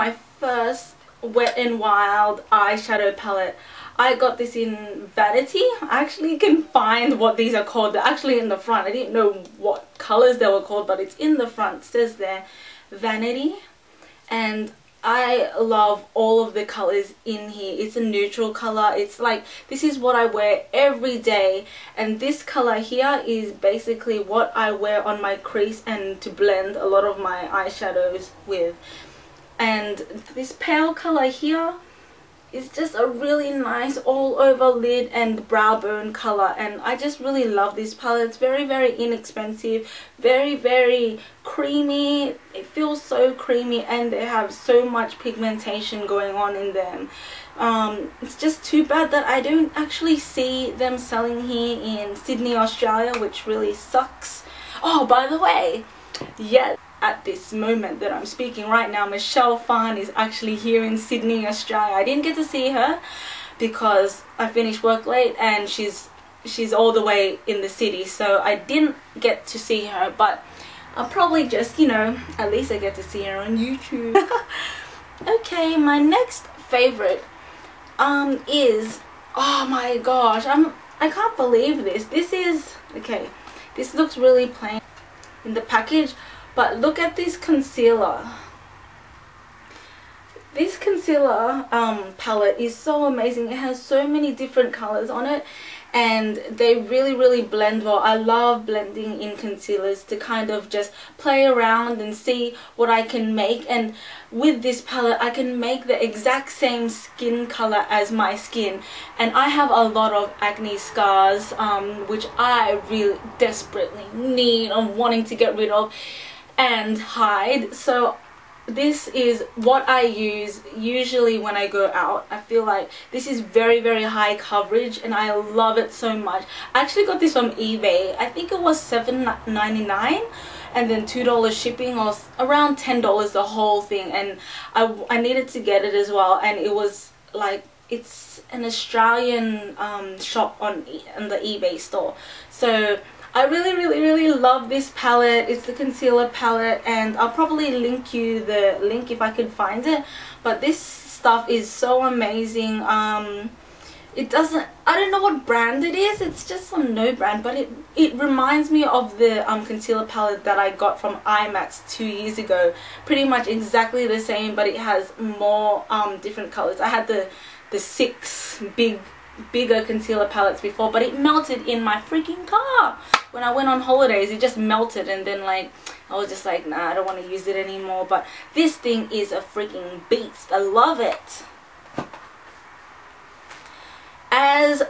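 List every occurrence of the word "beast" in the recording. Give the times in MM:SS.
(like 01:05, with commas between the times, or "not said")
03:00.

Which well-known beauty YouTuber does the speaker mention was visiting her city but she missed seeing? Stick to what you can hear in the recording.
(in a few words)
Michelle Phan.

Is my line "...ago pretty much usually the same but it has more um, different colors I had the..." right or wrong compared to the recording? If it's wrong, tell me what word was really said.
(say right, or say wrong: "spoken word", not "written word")
wrong: "exactly", not "usually".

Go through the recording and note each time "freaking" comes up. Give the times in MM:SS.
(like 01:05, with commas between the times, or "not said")
02:52, 02:59.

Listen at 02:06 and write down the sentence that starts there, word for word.
I actually got this from eBay.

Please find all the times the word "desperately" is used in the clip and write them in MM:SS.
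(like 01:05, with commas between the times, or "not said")
01:53.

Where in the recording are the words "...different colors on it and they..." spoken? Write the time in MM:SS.
01:34.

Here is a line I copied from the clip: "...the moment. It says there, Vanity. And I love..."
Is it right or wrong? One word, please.
wrong.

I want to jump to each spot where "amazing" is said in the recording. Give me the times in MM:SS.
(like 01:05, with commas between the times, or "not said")
01:33, 02:32.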